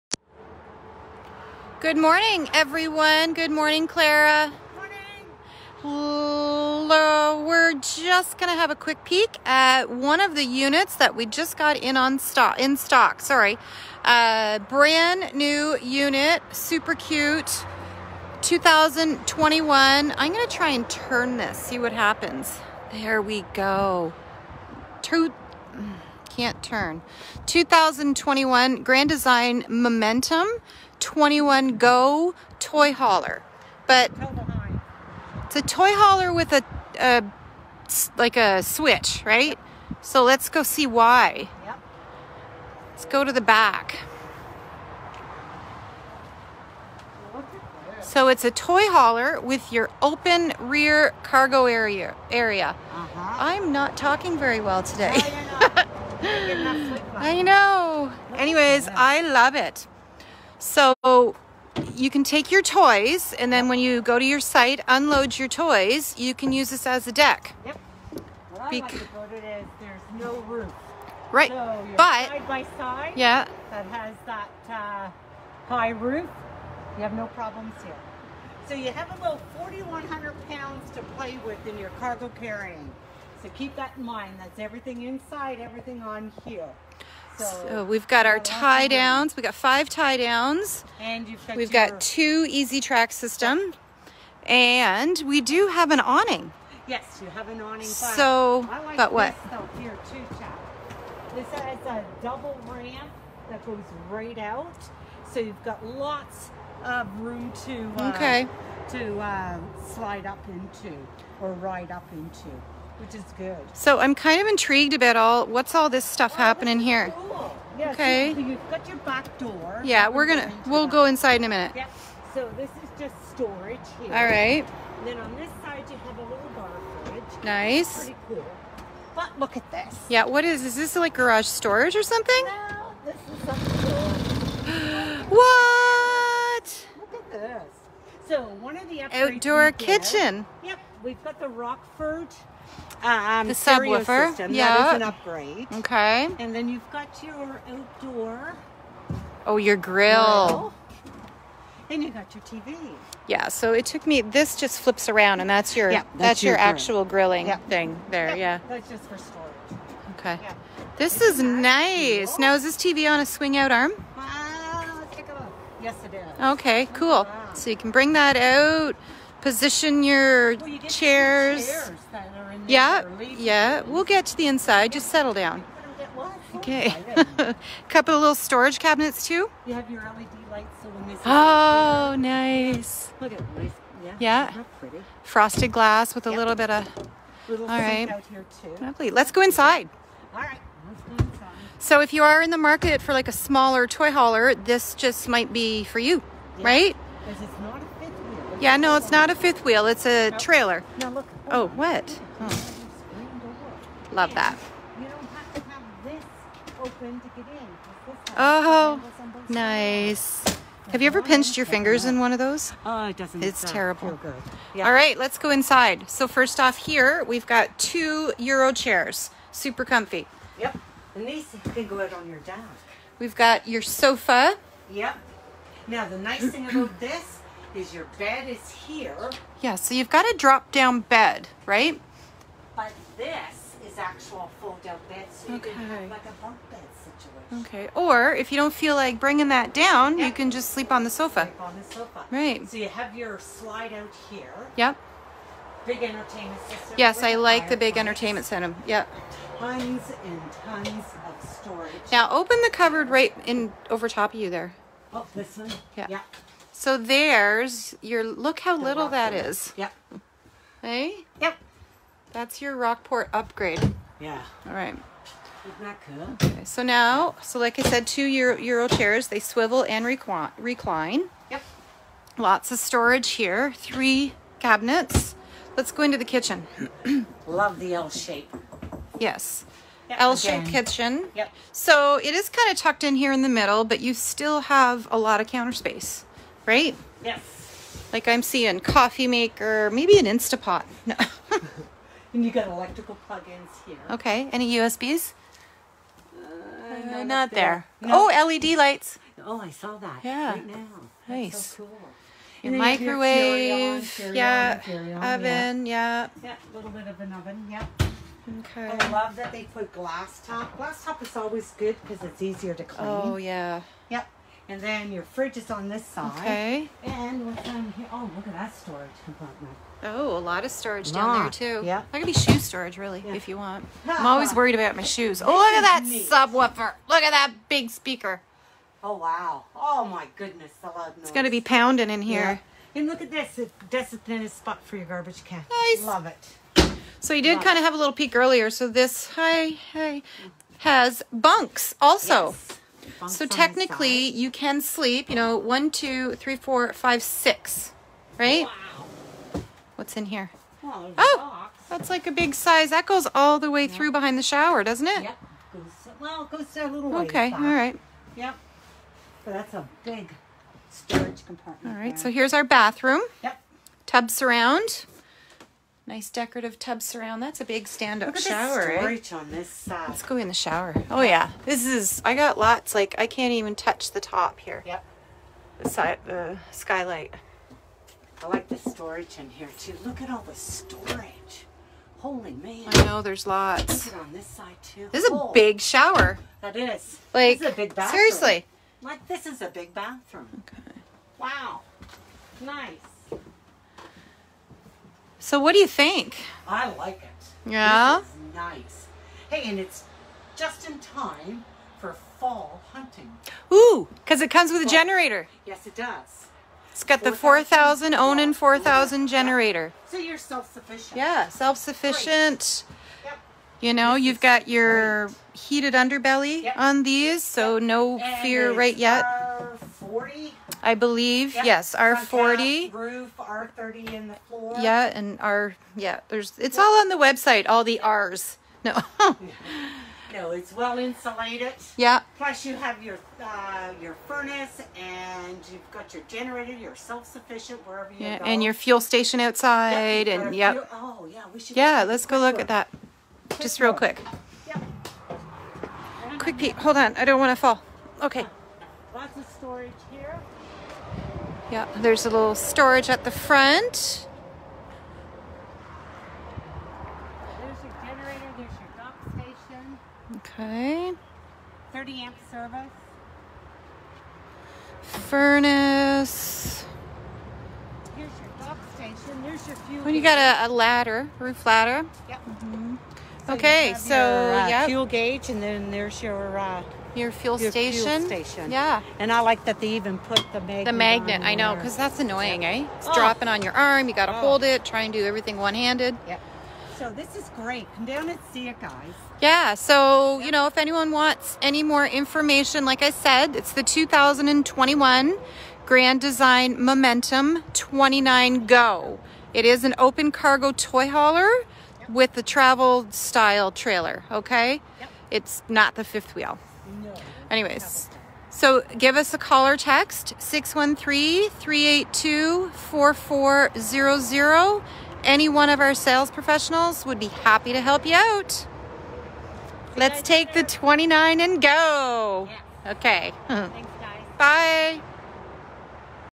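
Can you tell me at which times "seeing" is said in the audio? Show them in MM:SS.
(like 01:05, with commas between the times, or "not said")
04:48.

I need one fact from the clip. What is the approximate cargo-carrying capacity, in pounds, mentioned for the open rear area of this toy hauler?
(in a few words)
4,100 pounds.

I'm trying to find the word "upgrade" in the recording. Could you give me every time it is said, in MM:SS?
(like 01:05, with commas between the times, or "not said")
02:25, 04:23.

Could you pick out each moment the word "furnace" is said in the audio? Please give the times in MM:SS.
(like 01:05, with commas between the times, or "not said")
07:14, 07:45.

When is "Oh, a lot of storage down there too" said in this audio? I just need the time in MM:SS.
05:20.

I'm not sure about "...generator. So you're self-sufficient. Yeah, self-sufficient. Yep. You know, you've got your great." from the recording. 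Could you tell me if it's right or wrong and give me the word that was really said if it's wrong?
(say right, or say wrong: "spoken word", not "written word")
right.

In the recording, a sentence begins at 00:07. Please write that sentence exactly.
We're just going to have a quick peek at one of the units that we just got in on stock.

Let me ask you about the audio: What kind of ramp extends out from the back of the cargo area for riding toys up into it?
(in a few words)
Double ramp.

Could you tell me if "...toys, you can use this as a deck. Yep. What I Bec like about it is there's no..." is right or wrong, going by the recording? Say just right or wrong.
right.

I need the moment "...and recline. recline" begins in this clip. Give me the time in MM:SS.
04:29.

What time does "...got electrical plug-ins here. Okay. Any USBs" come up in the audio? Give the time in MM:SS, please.
04:52.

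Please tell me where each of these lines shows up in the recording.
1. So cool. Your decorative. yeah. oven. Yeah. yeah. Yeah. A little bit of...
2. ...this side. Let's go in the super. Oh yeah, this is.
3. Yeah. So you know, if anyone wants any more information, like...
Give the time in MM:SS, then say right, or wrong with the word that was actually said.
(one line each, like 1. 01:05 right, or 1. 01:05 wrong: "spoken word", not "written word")
1. 05:01 wrong: "microwave", not "decorative"
2. 06:09 wrong: "shower", not "super"
3. 08:09 right.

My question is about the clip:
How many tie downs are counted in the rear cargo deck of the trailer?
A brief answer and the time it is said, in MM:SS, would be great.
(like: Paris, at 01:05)
5, at 01:29.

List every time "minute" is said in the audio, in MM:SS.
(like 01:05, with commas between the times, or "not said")
02:01.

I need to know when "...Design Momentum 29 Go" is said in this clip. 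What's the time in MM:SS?
08:16.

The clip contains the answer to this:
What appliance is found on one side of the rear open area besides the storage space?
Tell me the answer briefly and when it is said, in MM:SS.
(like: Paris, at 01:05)
Bar fridge, at 02:06.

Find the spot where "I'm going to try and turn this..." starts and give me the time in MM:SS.
00:20.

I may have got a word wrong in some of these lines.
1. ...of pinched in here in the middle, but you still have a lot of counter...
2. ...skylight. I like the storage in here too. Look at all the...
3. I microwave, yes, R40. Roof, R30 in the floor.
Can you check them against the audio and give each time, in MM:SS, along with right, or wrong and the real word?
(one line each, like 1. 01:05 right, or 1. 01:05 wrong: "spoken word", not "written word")
1. 04:42 wrong: "tucked", not "pinched"
2. 06:16 right
3. 07:00 wrong: "believe", not "microwave".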